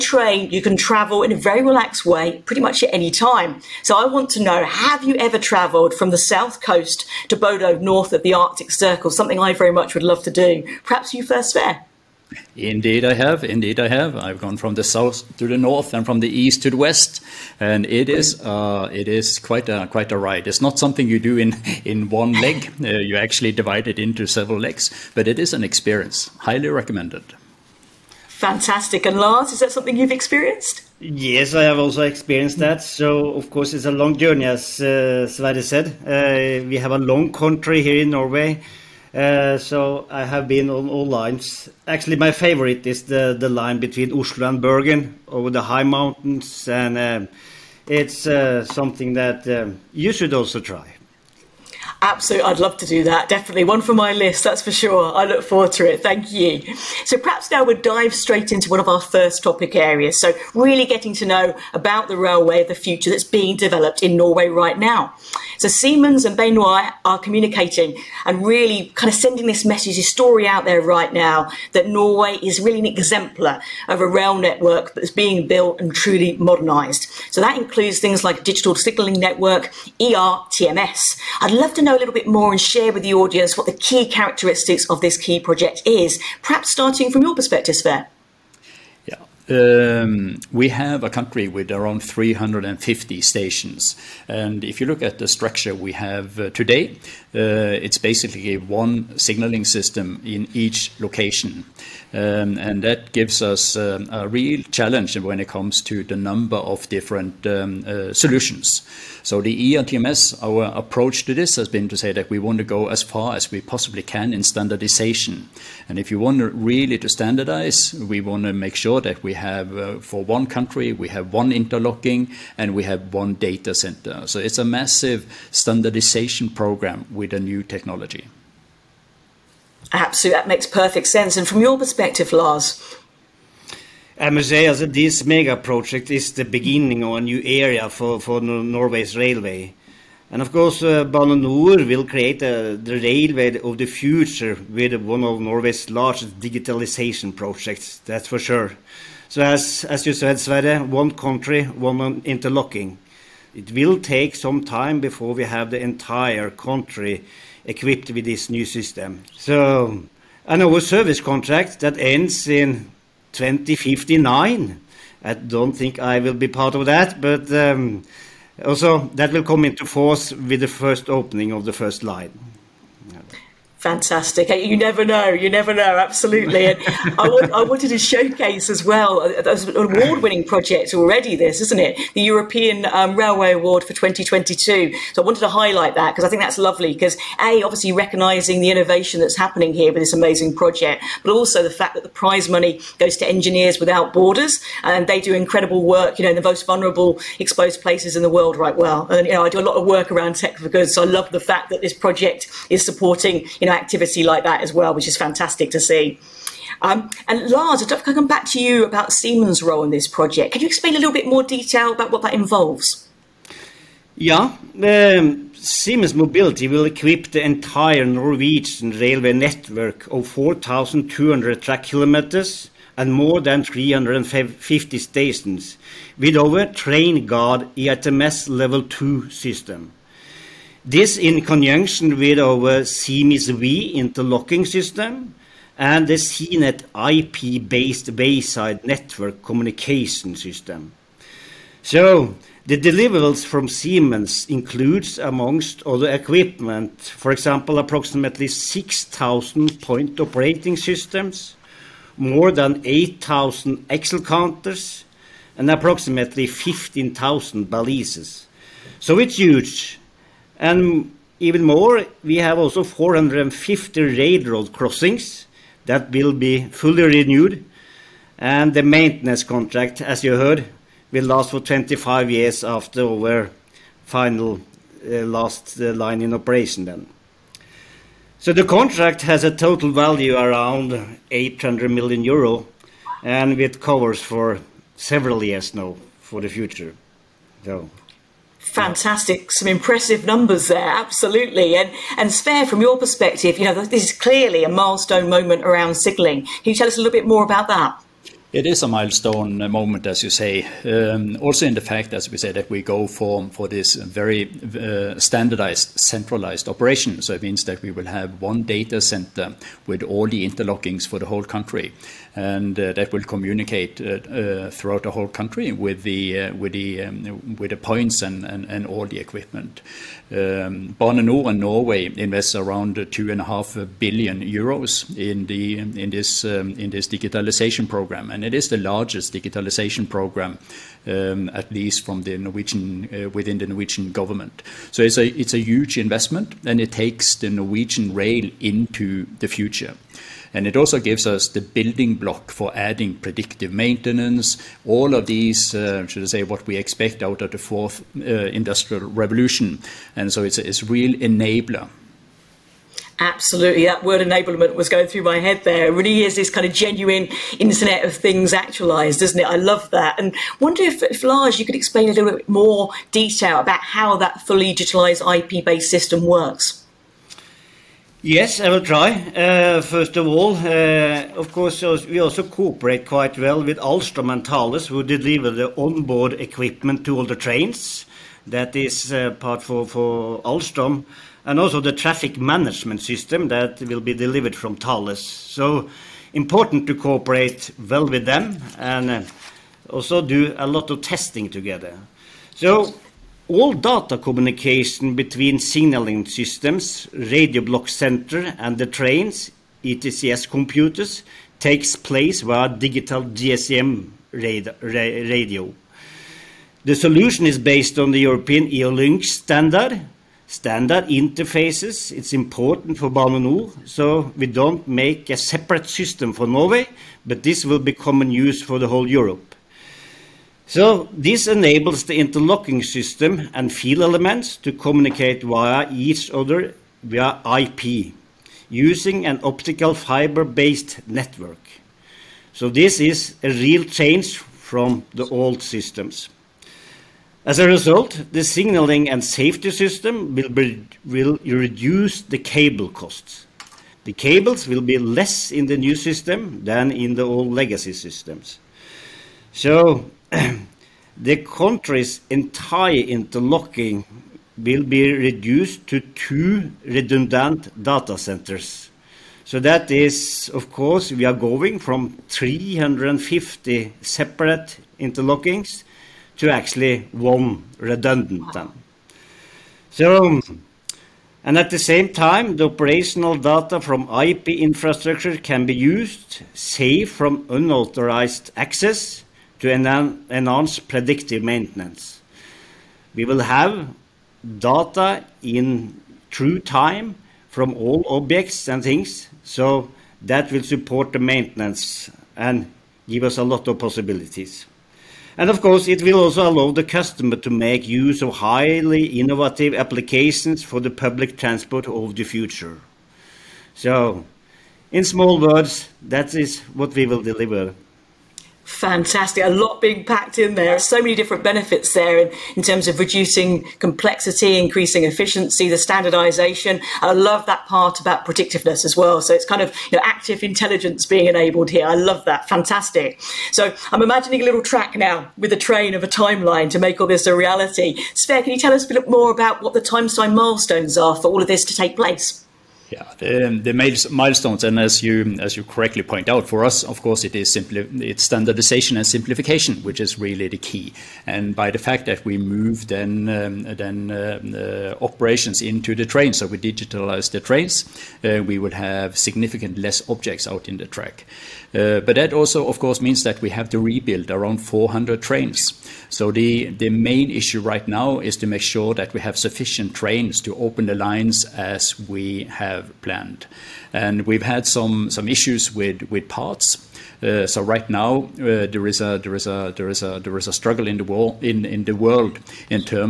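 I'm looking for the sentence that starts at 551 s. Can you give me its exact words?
Uh, but that also, of course, means that we have to rebuild around 400 trains.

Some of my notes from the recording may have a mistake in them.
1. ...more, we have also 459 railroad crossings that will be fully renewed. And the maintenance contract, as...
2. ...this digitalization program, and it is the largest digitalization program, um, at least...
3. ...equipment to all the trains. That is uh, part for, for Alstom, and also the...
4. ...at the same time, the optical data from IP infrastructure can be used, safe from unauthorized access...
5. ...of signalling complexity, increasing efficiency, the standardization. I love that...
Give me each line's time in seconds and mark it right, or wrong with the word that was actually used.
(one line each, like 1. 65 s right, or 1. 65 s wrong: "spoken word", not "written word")
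1. 261 s wrong: "450", not "459"
2. 326 s right
3. 376 s right
4. 471 s wrong: "operational", not "optical"
5. 512 s wrong: "reducing", not "signalling".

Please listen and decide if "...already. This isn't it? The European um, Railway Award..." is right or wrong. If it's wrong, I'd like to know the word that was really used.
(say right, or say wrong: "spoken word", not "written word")
right.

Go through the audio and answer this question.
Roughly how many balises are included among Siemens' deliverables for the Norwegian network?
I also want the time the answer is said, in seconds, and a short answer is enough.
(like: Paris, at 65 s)
15,000, at 256 s.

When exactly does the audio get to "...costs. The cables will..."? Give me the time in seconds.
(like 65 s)
442 s.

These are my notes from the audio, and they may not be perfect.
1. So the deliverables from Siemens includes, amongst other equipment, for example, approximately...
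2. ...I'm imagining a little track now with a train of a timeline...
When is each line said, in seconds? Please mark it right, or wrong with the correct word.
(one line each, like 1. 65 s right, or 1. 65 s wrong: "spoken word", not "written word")
1. 241 s right
2. 523 s right.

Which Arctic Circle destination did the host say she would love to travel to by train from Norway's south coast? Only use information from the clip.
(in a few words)
Bodø.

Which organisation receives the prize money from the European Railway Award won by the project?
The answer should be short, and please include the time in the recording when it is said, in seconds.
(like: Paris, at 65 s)
Engineers Without Borders, at 193 s.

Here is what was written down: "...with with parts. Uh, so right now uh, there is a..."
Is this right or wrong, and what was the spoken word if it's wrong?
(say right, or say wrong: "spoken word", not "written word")
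right.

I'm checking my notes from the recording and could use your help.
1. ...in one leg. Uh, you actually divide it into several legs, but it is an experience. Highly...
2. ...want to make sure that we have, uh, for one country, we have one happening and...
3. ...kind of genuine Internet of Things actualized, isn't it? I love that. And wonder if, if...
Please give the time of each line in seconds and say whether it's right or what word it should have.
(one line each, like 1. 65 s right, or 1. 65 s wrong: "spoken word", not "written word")
1. 21 s right
2. 118 s wrong: "interlocking", not "happening"
3. 356 s right.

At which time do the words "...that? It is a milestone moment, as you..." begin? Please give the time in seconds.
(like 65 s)
297 s.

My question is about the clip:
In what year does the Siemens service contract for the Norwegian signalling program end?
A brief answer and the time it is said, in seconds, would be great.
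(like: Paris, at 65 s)
2059, at 163 s.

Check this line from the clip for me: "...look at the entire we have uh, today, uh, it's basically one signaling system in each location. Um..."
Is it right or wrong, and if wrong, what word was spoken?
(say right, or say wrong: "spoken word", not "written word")
wrong: "structure", not "entire".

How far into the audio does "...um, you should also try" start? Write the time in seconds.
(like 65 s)
49 s.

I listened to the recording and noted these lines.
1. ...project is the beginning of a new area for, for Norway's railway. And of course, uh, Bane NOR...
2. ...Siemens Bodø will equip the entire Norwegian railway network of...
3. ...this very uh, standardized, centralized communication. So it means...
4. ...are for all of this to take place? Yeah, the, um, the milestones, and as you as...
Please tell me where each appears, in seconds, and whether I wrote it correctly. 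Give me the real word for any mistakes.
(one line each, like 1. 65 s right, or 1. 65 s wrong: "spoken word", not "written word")
1. 135 s right
2. 215 s wrong: "Mobility", not "Bodø"
3. 303 s wrong: "operation", not "communication"
4. 530 s right.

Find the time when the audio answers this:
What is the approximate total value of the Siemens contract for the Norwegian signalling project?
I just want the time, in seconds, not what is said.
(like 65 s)
281 s.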